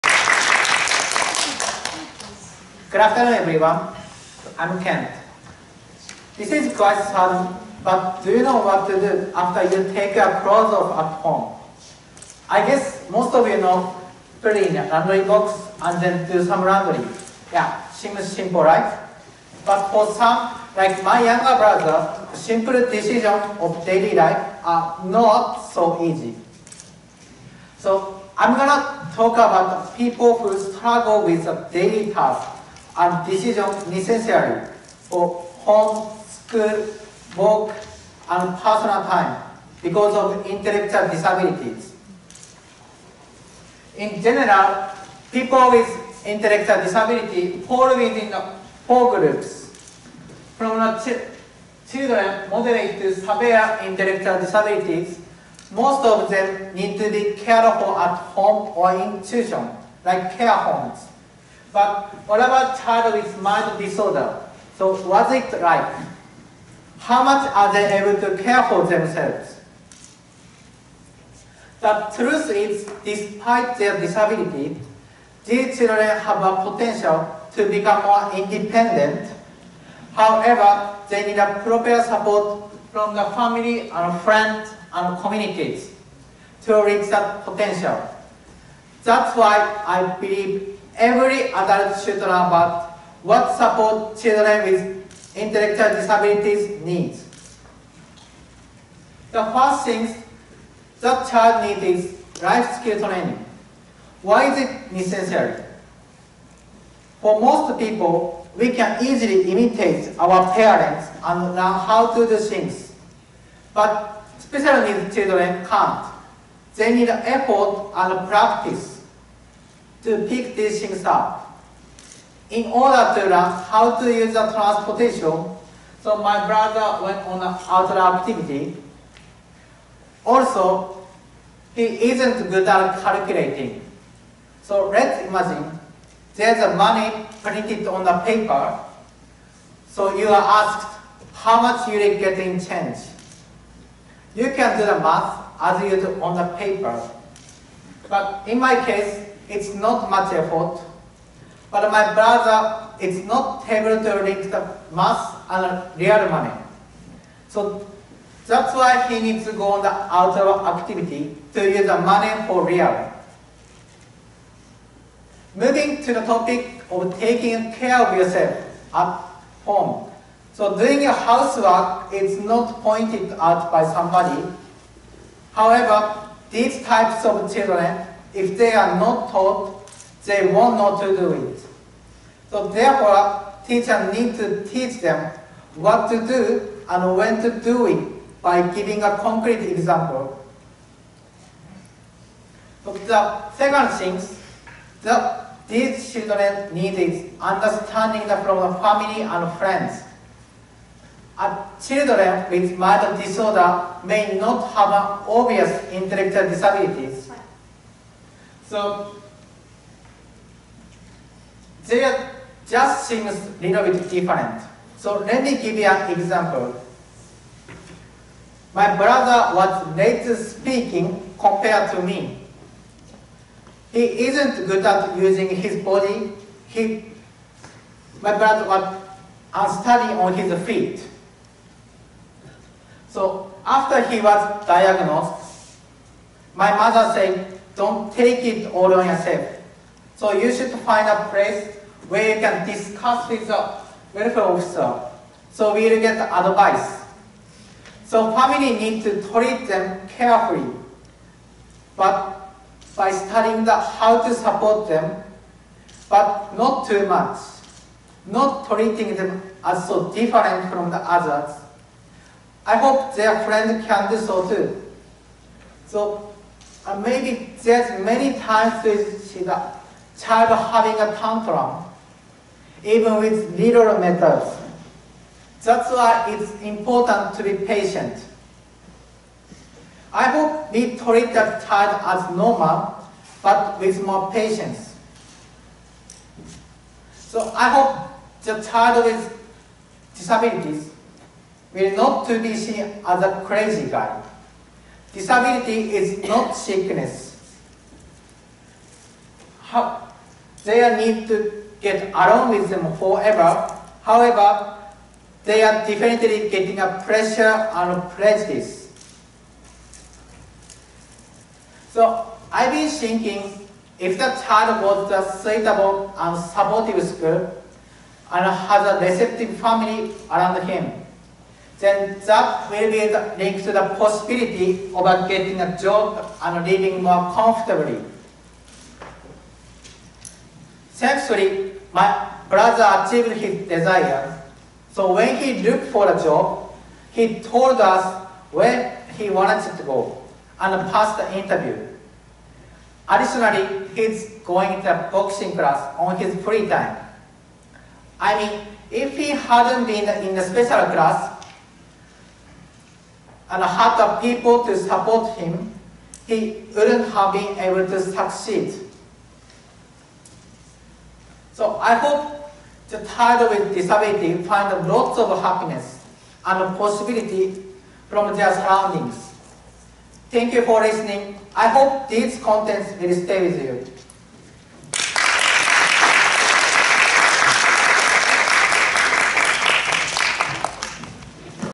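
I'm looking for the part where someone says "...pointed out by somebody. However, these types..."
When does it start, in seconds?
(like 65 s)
172 s.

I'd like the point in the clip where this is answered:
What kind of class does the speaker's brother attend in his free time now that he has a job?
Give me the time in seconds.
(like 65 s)
345 s.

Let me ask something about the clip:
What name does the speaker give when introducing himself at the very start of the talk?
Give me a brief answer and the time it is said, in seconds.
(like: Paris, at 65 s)
Kento, at 4 s.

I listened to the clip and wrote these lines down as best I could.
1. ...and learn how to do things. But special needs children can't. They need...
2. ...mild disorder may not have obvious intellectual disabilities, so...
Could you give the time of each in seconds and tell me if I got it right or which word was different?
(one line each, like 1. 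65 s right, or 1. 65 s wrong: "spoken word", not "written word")
1. 111 s right
2. 202 s right.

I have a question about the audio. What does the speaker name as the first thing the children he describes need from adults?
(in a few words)
life skill training.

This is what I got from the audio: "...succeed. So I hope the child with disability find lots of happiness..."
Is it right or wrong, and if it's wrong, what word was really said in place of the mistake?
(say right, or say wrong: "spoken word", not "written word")
right.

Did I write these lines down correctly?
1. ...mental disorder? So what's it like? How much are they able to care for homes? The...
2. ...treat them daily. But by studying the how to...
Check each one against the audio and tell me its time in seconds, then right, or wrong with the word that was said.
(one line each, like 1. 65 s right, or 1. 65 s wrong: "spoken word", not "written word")
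1. 63 s wrong: "themselves", not "homes"
2. 249 s wrong: "carefully", not "daily".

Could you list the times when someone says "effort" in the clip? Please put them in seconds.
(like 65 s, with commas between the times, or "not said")
117 s, 150 s.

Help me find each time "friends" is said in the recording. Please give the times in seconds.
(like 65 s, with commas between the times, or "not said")
84 s, 199 s, 263 s.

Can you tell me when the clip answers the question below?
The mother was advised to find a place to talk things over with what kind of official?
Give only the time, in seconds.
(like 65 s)
244 s.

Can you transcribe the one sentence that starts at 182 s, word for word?
So therefore, teachers need to teach them what to do and when to do it by giving a concrete example.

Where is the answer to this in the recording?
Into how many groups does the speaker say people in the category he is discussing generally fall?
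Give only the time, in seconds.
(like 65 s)
48 s.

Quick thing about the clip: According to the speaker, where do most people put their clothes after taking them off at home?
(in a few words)
laundry box.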